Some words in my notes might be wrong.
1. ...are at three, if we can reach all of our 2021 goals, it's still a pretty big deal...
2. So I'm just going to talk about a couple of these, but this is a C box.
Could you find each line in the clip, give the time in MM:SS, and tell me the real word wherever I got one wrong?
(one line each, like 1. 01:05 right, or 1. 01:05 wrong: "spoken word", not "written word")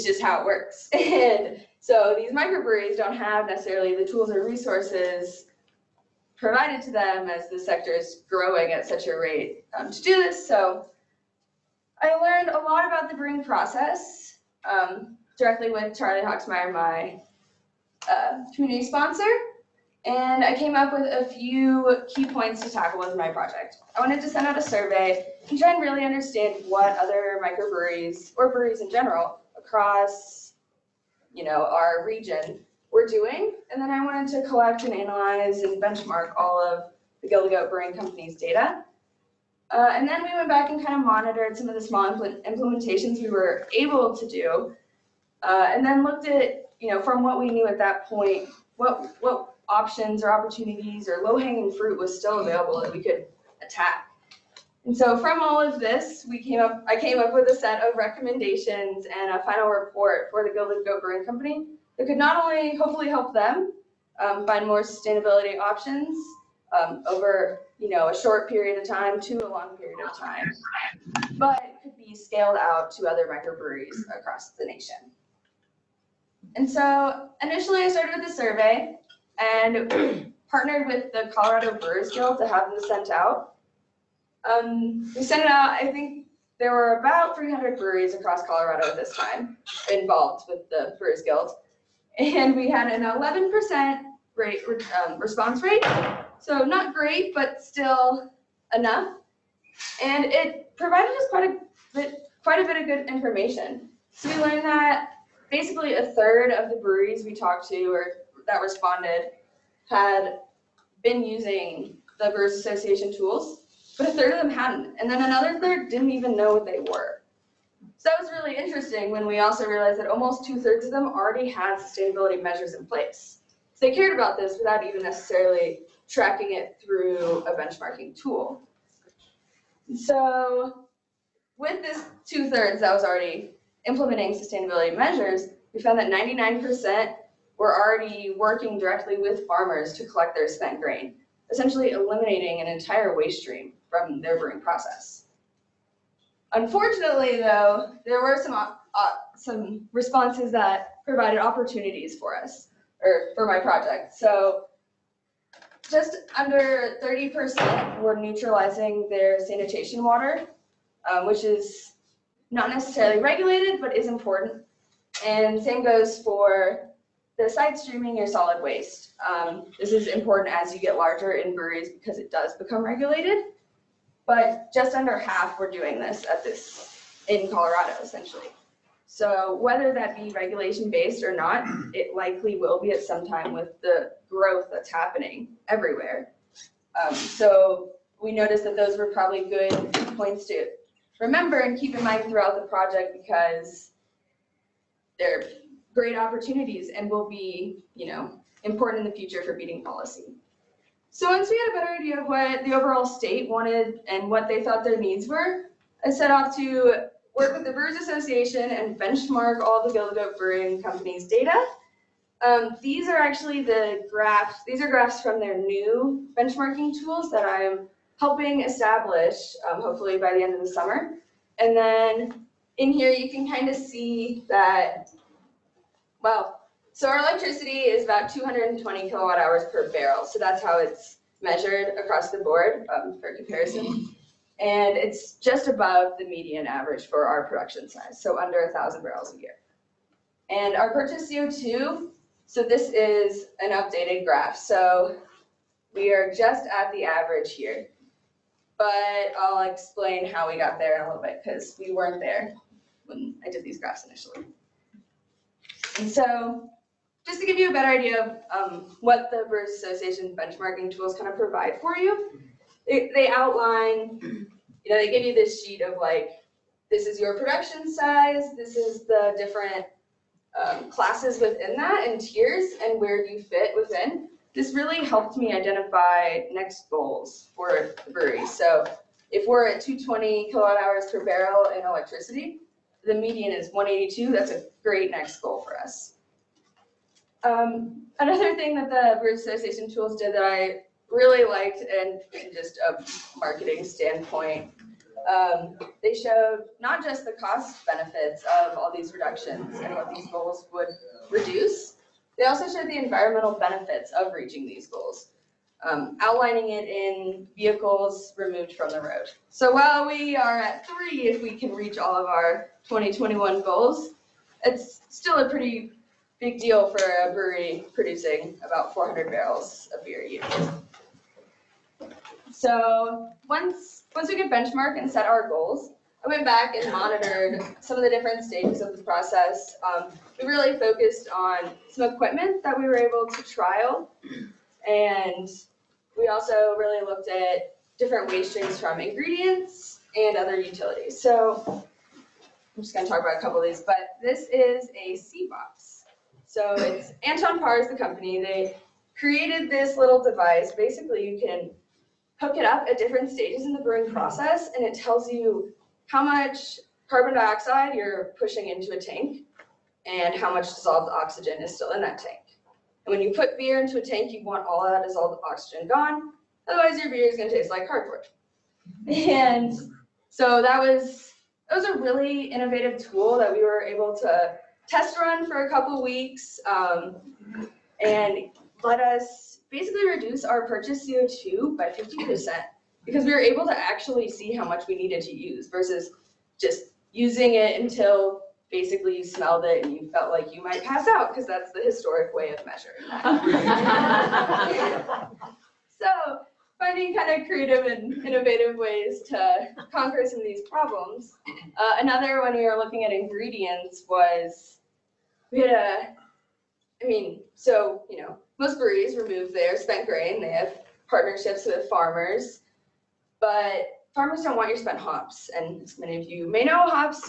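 1. 05:10 right
2. 05:41 right.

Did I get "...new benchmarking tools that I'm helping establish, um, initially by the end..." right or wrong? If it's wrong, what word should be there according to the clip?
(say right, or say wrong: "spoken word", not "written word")
wrong: "hopefully", not "initially".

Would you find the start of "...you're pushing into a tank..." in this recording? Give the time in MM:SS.
05:57.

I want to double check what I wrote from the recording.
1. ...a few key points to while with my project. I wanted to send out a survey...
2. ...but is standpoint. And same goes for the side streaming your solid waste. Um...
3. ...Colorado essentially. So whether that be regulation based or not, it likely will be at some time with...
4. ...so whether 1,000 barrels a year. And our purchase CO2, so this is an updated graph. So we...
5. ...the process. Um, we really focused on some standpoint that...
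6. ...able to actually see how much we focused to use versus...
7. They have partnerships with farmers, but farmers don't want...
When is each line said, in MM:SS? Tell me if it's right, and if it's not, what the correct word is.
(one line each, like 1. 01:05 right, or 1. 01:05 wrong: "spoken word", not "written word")
1. 00:21 wrong: "tackle", not "while"
2. 02:43 wrong: "important", not "standpoint"
3. 02:57 right
4. 03:58 wrong: "under", not "whether"
5. 05:28 wrong: "equipment", not "standpoint"
6. 06:23 wrong: "needed", not "focused"
7. 06:50 right.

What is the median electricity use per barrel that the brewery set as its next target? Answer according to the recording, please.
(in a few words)
182.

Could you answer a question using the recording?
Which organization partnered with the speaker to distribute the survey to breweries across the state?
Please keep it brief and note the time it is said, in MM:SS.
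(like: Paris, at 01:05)
Colorado Brewers Guild, at 01:21.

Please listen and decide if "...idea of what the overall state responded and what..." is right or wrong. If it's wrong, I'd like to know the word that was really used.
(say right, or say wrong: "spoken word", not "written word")
wrong: "wanted", not "responded".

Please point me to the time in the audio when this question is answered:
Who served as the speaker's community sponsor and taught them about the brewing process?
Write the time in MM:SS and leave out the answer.
00:15.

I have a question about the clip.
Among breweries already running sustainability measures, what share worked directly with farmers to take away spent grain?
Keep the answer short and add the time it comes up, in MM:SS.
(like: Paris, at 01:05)
99%, at 02:16.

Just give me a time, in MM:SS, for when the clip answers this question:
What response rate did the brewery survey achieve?
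01:33.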